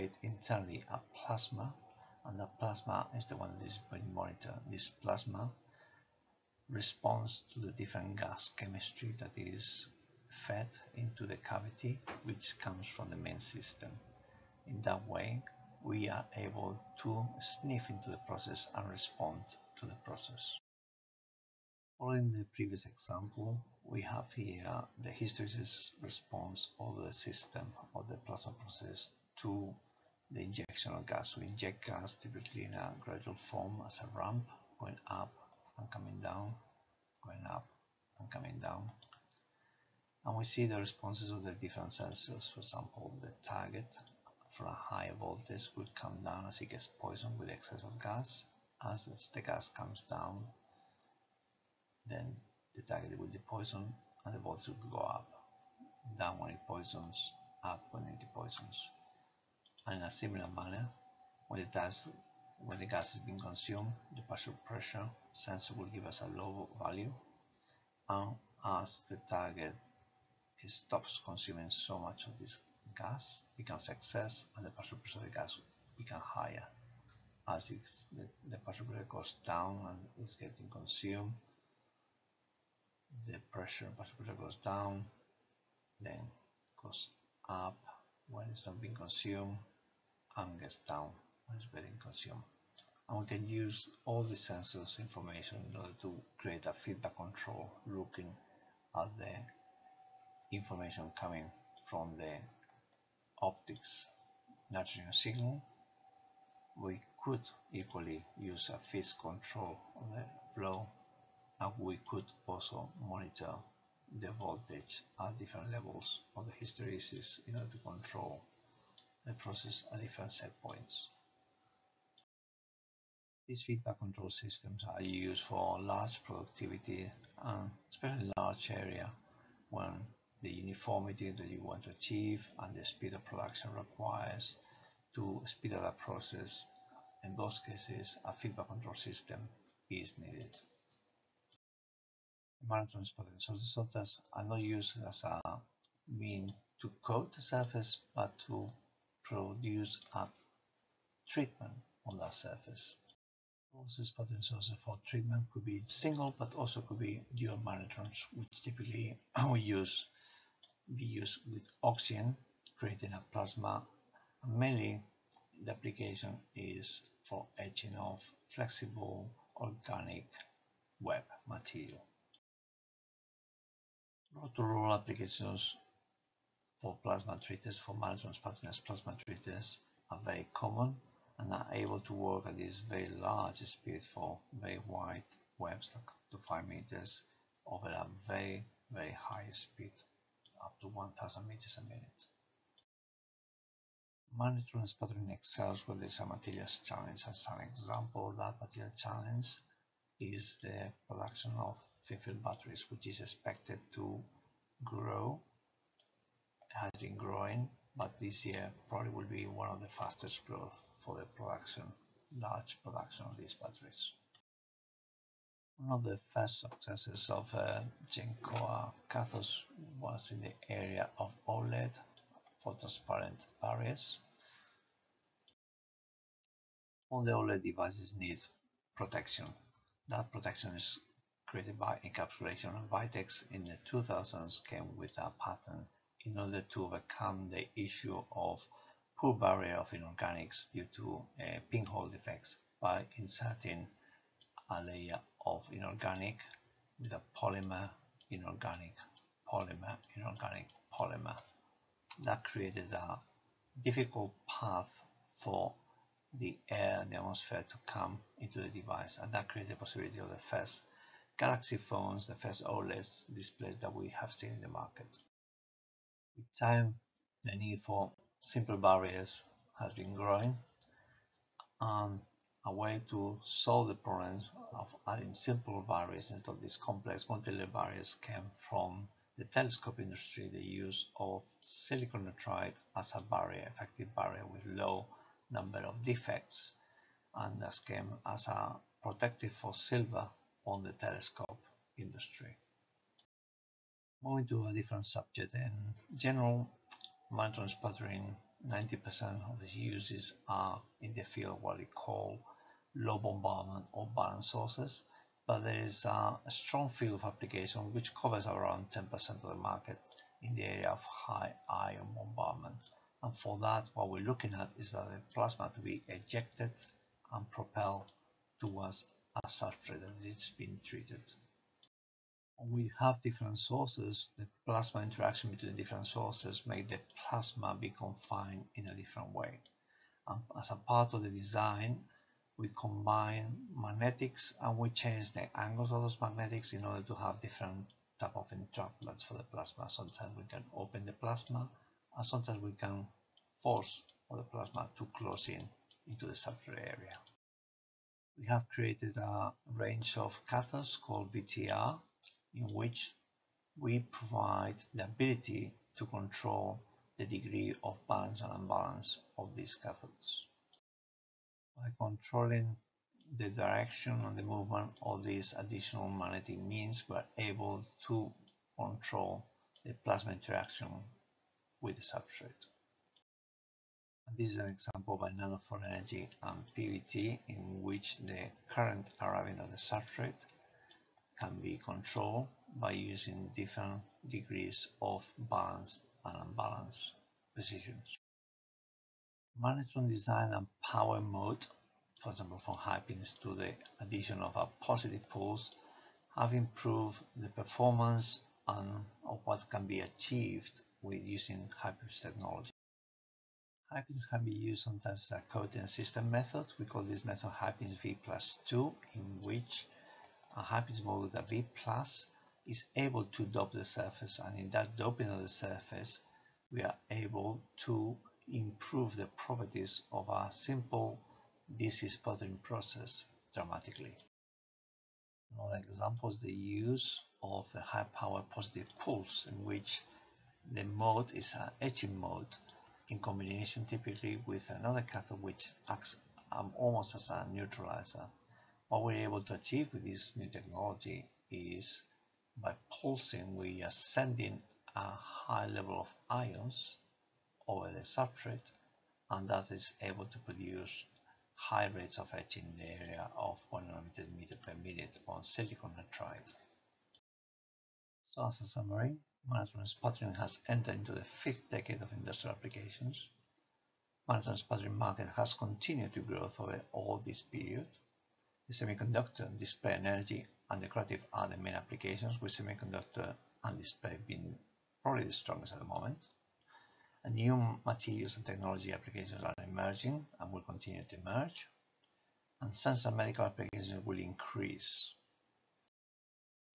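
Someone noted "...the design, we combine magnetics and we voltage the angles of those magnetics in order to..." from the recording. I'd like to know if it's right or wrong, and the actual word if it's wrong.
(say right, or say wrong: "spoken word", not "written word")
wrong: "change", not "voltage".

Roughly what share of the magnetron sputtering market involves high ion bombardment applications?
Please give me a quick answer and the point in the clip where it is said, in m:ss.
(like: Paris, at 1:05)
10%, at 5:08.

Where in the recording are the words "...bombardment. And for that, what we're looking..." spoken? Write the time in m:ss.
5:12.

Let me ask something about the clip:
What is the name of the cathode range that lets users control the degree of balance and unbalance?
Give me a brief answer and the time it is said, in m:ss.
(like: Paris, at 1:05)
VTR, at 5:51.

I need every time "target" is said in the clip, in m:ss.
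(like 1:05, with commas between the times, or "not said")
0:43, 0:52, 1:09.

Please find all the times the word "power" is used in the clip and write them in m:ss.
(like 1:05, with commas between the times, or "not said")
6:30, 7:08.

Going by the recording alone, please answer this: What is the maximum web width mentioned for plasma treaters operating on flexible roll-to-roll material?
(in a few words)
5 meters.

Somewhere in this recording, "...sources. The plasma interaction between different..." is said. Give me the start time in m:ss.
5:23.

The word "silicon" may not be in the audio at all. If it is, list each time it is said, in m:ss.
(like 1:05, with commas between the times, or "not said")
4:41, 7:35.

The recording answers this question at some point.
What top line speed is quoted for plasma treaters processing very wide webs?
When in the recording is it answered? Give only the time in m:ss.
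3:10.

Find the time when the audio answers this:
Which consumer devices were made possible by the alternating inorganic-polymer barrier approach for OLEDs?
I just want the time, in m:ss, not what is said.
4:21.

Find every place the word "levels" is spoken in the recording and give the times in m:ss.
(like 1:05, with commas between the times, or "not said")
1:55, 7:25.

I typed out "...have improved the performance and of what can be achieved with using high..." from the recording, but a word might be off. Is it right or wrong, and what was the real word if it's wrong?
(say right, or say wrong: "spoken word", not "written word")
right.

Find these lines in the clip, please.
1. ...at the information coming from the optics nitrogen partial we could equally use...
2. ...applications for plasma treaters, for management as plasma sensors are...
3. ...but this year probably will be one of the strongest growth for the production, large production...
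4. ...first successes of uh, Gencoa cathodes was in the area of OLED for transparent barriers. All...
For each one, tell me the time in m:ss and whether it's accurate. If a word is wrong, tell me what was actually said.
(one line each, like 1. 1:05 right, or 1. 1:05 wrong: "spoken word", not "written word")
1. 1:39 wrong: "signal", not "partial"
2. 2:54 wrong: "treaters", not "sensors"
3. 3:27 wrong: "fastest", not "strongest"
4. 3:36 right.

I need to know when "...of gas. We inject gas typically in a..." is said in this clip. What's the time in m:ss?
0:30.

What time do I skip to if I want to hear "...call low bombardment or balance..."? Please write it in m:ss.
5:01.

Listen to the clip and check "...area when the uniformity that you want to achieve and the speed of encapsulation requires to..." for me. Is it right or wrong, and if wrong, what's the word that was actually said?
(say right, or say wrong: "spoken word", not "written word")
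wrong: "production", not "encapsulation".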